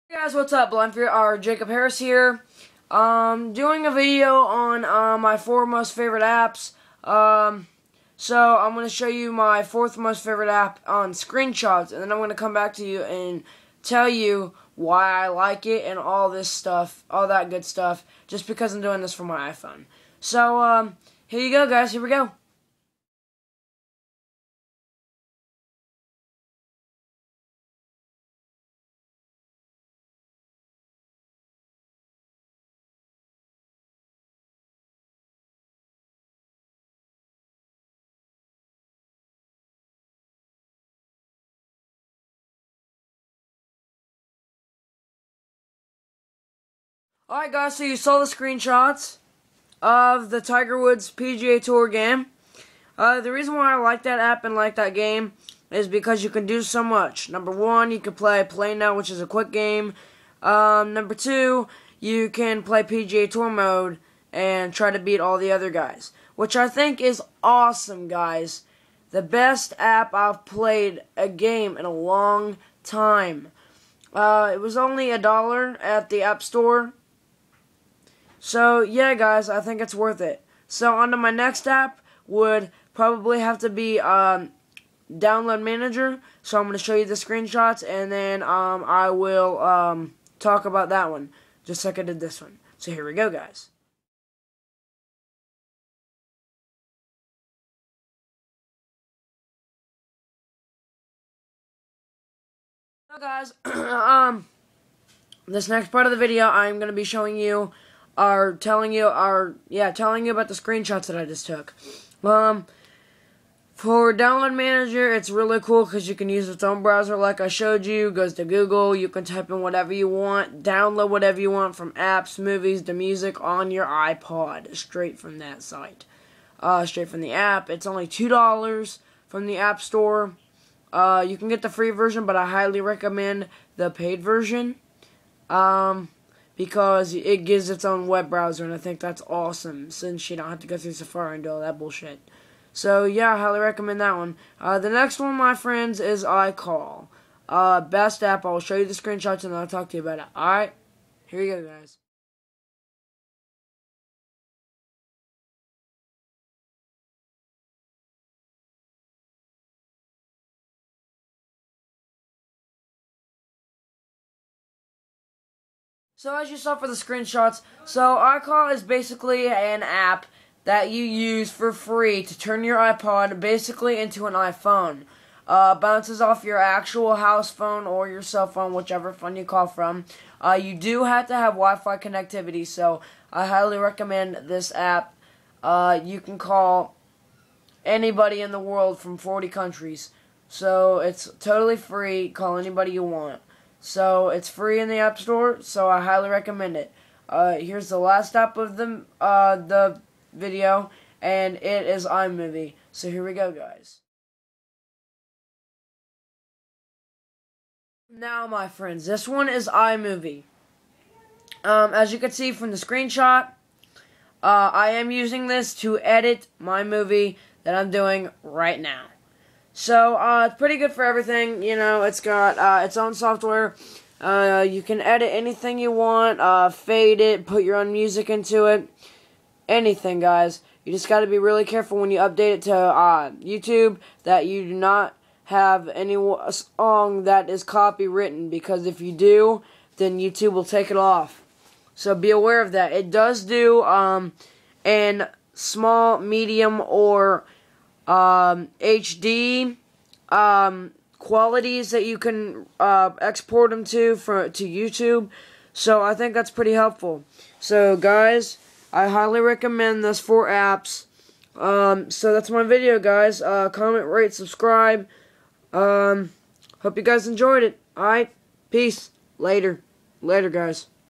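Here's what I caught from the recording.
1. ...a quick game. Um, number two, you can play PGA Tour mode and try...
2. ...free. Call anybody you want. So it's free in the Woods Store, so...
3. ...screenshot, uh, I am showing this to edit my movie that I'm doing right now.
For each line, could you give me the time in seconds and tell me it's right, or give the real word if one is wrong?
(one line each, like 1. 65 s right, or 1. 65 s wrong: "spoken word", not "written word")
1. 59 s right
2. 191 s wrong: "App", not "Woods"
3. 212 s wrong: "using", not "showing".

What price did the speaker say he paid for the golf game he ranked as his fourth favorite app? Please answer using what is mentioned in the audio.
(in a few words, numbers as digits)
$1.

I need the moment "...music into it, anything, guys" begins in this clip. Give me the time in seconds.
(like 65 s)
227 s.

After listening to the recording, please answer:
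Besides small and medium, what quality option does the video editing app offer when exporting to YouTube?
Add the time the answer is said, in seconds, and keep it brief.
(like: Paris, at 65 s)
HD, at 248 s.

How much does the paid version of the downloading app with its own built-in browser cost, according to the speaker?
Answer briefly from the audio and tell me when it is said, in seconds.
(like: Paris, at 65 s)
$2, at 128 s.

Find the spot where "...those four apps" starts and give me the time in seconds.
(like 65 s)
260 s.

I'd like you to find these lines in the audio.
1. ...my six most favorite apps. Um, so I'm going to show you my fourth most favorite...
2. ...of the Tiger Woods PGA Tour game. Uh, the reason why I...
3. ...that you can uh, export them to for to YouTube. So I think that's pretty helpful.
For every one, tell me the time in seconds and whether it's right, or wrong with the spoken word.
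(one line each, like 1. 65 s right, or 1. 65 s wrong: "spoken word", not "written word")
1. 5 s wrong: "four", not "six"
2. 49 s right
3. 251 s right.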